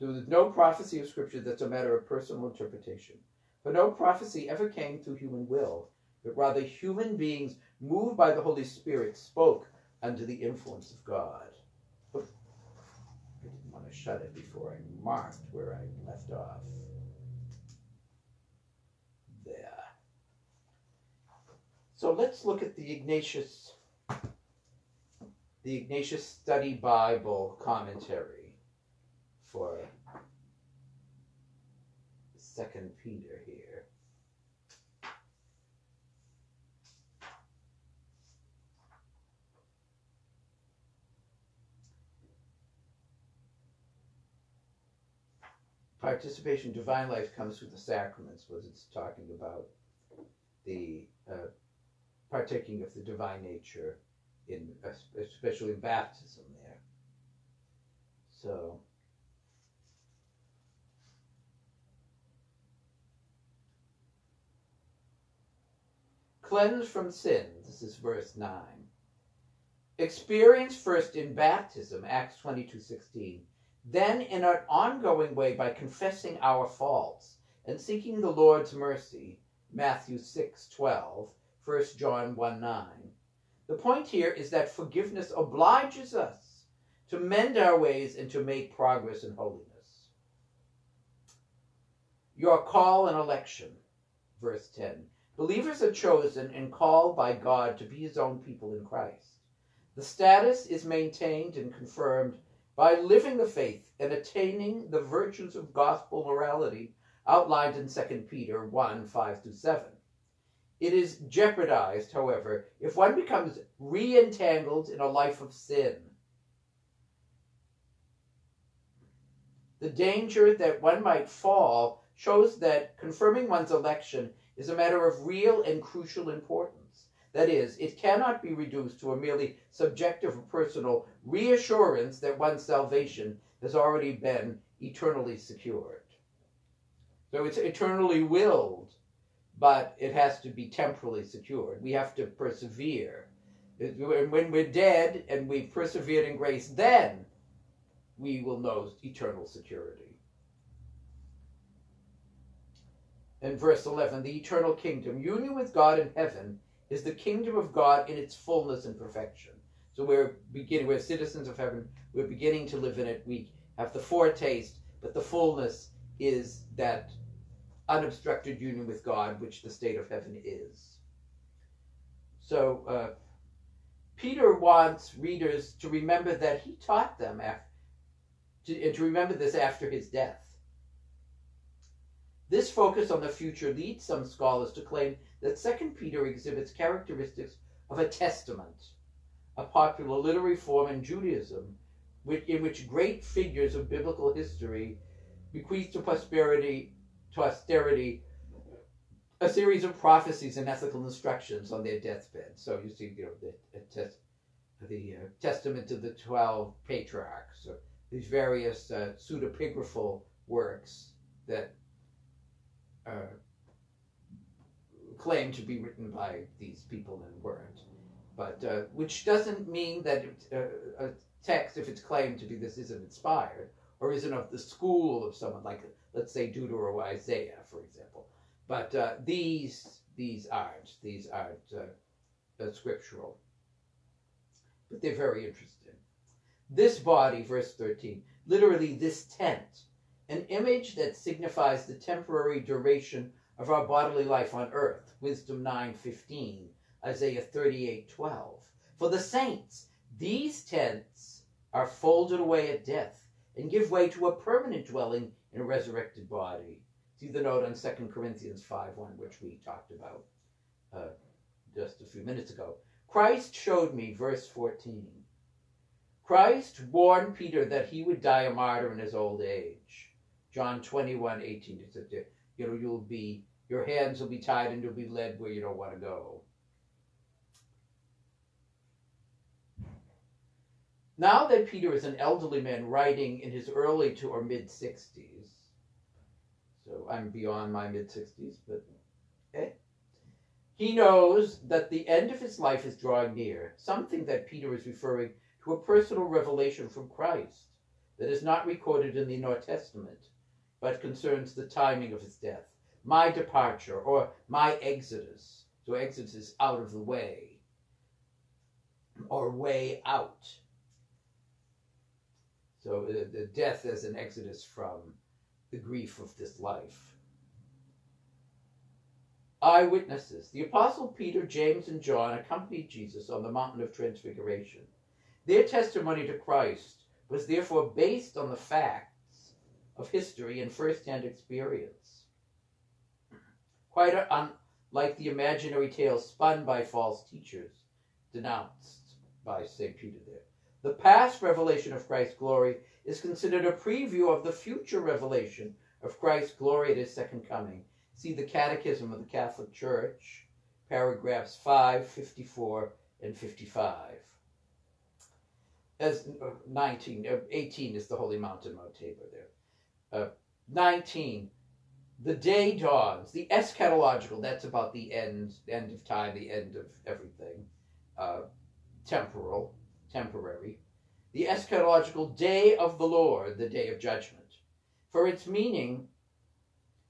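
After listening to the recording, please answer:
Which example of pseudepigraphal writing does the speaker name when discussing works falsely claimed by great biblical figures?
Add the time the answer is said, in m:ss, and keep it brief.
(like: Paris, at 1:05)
Testament of the Twelve Patriarchs, at 3:25.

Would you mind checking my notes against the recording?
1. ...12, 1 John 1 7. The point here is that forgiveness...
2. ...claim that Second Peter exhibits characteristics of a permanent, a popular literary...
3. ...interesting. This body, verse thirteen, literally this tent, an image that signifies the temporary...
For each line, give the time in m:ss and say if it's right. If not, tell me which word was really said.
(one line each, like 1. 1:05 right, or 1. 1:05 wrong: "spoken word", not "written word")
1. 1:20 wrong: "9", not "7"
2. 3:04 wrong: "testament", not "permanent"
3. 3:55 right.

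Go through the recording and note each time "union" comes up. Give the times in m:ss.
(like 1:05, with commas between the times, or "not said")
2:35, 2:48.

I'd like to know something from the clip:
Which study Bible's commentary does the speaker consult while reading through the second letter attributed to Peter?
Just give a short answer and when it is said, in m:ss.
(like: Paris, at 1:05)
Ignatius Study Bible, at 0:25.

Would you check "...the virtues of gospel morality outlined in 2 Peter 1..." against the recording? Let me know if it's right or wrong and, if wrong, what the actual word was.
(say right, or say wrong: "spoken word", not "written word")
right.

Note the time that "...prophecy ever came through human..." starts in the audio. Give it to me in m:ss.
0:03.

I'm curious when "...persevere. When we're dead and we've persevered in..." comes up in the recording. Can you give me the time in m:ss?
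2:22.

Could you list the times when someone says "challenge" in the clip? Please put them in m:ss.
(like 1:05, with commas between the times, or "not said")
not said.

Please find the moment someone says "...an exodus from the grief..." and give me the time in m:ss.
5:14.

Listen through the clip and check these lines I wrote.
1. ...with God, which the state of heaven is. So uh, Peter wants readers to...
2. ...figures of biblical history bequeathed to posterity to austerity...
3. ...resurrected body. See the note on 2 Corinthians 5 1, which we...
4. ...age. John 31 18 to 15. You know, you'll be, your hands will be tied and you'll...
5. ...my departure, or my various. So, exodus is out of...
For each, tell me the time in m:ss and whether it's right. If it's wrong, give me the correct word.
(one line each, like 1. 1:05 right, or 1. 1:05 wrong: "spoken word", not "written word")
1. 2:48 right
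2. 3:13 right
3. 4:15 right
4. 4:29 wrong: "21", not "31"
5. 5:03 wrong: "exodus", not "various".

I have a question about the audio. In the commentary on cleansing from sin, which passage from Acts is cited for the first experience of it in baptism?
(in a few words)
Acts 22:16.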